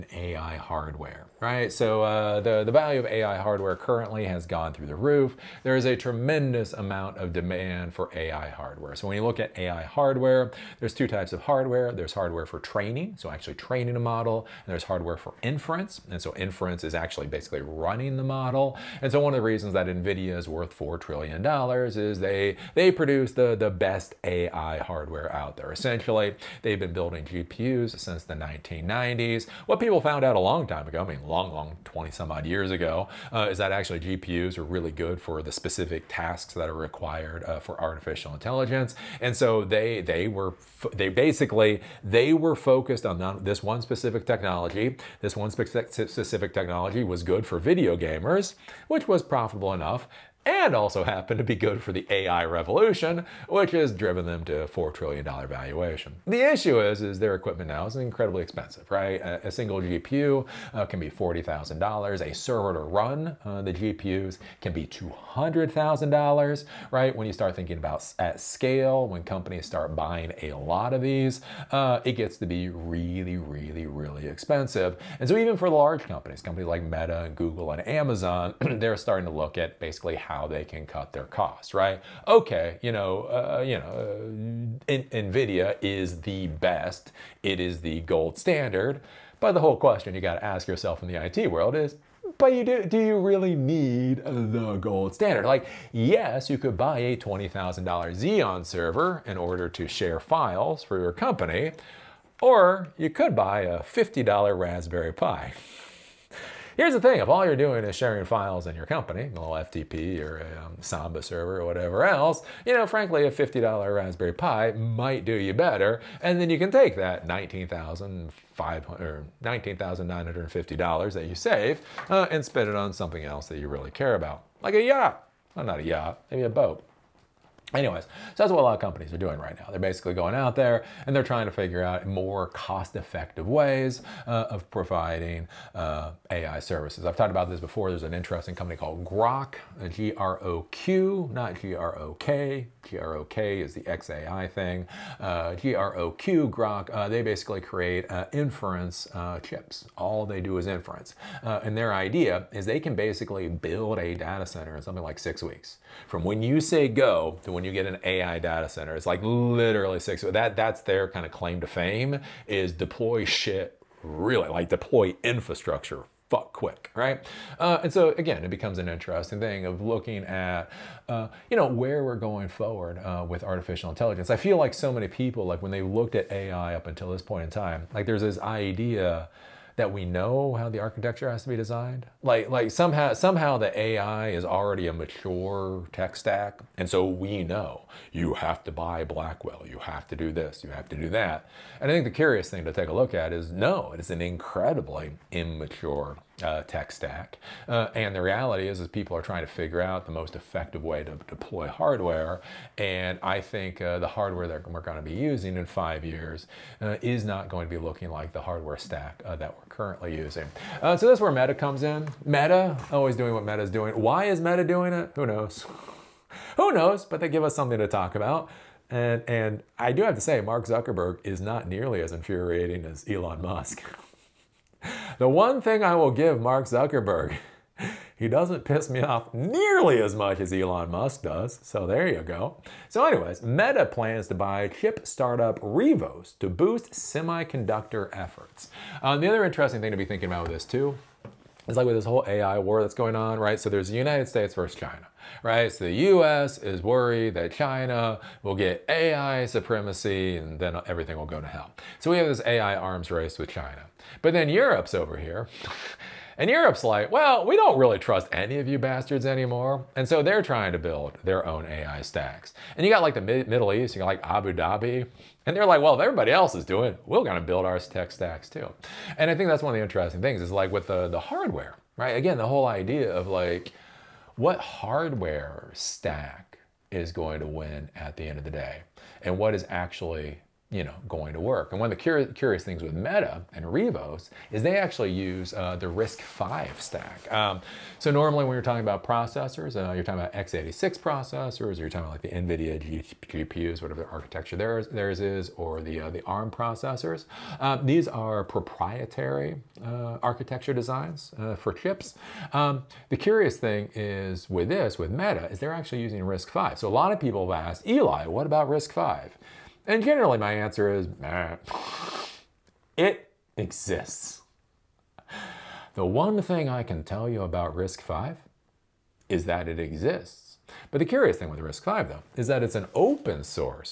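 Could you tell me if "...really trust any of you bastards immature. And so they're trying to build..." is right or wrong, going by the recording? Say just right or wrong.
wrong.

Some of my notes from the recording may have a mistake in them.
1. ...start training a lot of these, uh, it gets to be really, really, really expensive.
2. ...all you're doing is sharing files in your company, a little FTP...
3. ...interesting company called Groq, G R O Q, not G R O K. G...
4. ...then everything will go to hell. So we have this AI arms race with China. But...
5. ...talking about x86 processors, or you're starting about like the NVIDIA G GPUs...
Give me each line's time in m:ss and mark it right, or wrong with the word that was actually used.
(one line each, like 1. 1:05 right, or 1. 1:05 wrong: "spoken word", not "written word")
1. 1:09 wrong: "buying", not "training"
2. 1:47 right
3. 2:18 right
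4. 4:10 right
5. 4:50 wrong: "talking", not "starting".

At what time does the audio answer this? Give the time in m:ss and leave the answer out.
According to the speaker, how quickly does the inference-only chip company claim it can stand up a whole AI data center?
2:35.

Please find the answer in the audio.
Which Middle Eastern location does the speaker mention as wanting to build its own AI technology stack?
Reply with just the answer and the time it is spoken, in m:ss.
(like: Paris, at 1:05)
Abu Dhabi, at 4:24.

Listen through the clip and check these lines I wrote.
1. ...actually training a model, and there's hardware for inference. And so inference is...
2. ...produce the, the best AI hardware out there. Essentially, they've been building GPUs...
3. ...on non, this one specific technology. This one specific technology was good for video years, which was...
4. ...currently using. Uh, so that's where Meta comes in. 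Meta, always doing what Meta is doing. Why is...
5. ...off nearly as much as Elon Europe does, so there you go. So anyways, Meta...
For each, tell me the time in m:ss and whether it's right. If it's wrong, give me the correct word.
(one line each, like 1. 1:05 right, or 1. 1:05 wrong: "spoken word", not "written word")
1. 0:13 right
2. 0:22 right
3. 0:43 wrong: "gamers", not "years"
4. 3:29 right
5. 3:49 wrong: "Musk", not "Europe".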